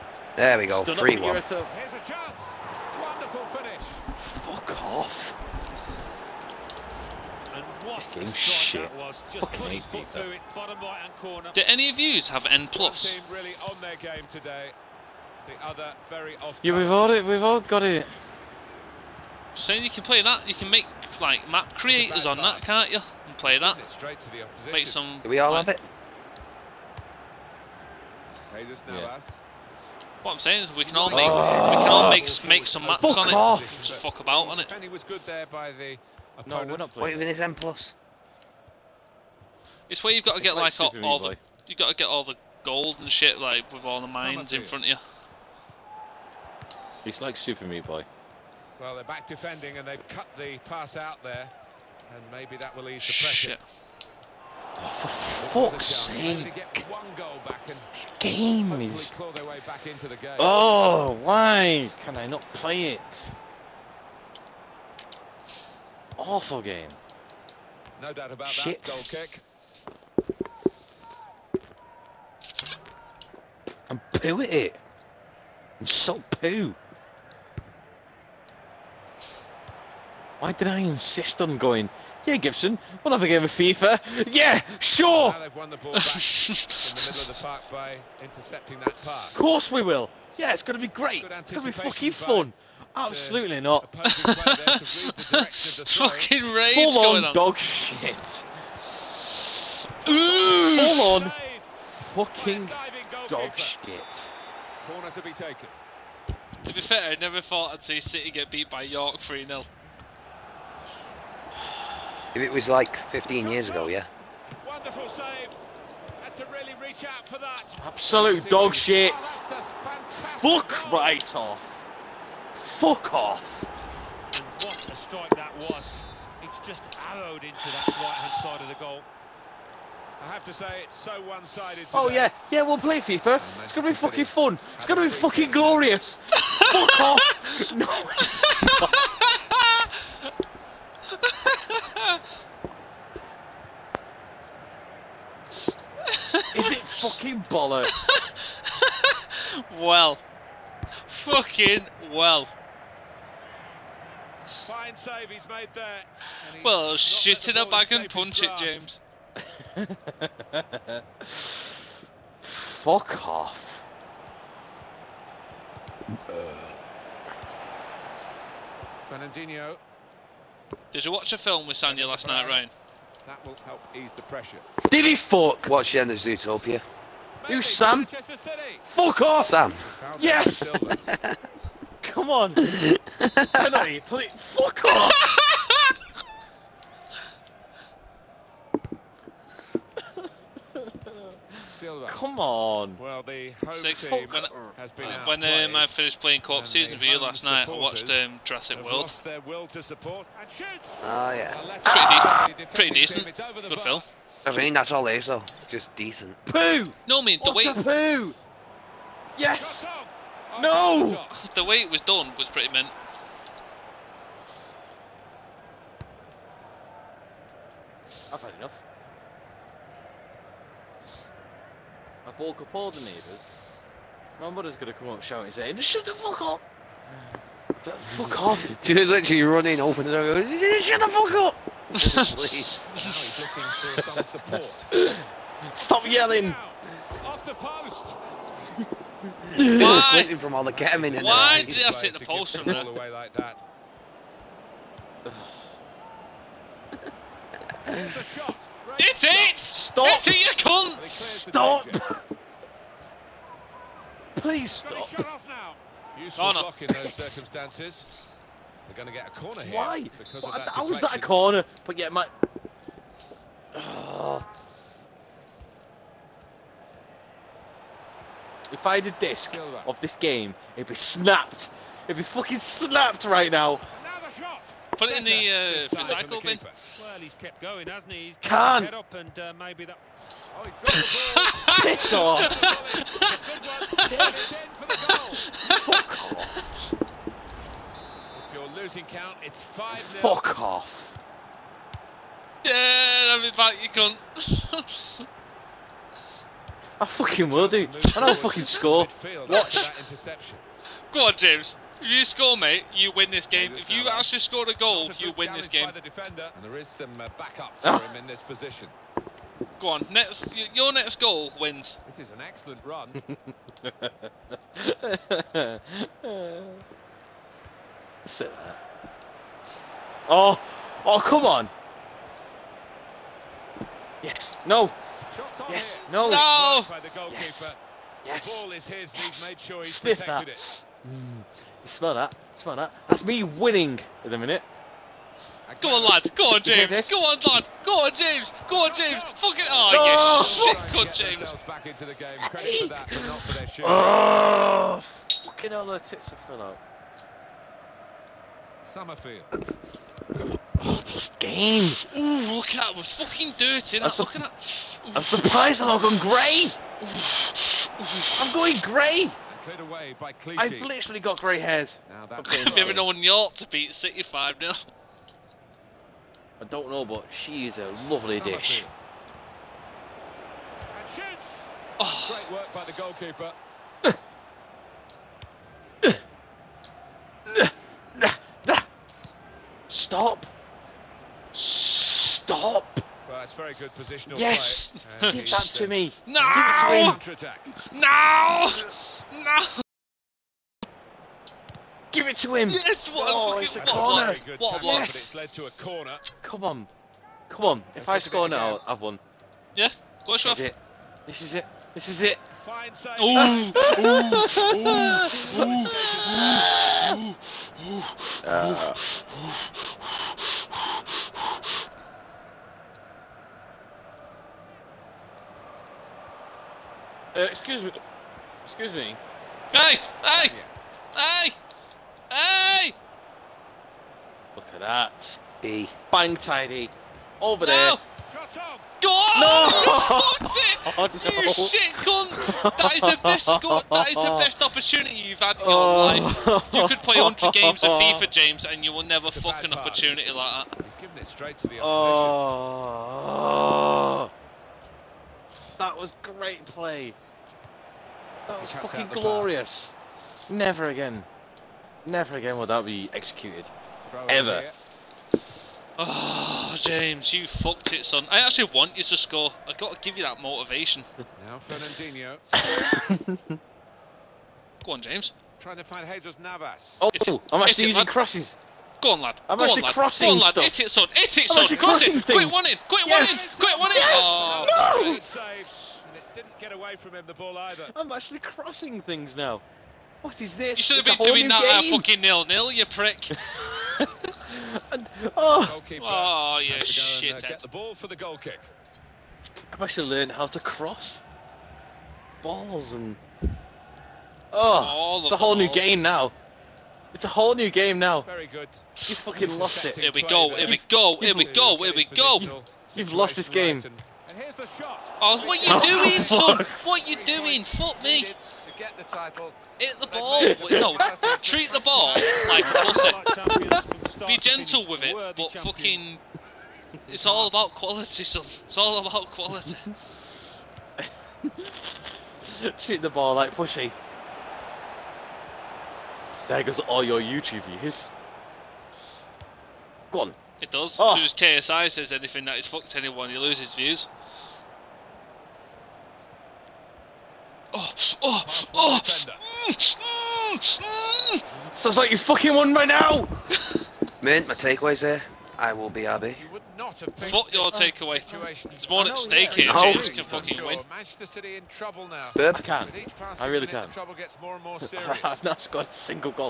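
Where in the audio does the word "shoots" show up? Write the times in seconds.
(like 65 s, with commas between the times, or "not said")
371 s.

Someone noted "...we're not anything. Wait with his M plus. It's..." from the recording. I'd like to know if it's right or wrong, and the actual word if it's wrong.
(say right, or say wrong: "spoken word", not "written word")
wrong: "playing", not "anything".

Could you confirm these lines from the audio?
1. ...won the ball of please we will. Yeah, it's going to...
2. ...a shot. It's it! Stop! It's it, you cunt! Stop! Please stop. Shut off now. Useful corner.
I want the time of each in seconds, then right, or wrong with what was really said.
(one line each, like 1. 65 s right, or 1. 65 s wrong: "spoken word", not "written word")
1. 85 s wrong: "course", not "please"
2. 248 s right.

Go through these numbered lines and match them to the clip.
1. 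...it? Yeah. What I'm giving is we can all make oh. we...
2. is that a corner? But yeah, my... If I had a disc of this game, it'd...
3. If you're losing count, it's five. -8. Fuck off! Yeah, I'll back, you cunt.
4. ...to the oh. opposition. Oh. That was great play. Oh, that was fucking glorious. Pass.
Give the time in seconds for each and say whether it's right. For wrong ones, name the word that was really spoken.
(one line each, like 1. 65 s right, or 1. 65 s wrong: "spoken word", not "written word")
1. 25 s wrong: "saying", not "giving"
2. 260 s right
3. 286 s wrong: "0", not "8"
4. 441 s right.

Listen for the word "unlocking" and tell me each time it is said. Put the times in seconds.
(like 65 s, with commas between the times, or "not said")
not said.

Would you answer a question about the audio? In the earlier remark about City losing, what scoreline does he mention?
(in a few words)
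3-0.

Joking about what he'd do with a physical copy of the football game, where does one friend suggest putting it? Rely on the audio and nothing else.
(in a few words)
Recycle bin.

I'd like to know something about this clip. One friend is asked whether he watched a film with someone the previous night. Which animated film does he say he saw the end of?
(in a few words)
Zootopia.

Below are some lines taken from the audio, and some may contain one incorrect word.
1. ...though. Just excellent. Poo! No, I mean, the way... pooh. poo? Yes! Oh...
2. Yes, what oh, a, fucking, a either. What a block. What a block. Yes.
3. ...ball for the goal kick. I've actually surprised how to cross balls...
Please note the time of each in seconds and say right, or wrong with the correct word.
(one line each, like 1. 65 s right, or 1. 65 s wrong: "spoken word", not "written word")
1. 205 s wrong: "decent", not "excellent"
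2. 392 s wrong: "corner", not "either"
3. 487 s wrong: "learned", not "surprised".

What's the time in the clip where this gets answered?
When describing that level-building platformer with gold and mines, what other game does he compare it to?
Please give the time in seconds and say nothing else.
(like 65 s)
47 s.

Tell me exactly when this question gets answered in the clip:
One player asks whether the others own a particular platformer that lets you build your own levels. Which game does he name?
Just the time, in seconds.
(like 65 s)
12 s.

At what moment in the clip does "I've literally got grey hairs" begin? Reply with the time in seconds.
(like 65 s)
360 s.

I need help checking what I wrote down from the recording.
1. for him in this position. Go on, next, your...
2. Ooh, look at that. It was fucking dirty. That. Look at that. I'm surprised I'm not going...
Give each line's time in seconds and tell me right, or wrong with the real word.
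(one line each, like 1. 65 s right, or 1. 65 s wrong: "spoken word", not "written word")
1. 307 s right
2. 352 s right.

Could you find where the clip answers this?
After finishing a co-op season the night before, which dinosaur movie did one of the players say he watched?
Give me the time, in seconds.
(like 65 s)
198 s.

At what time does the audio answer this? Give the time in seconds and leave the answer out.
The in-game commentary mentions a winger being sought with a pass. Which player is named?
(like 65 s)
466 s.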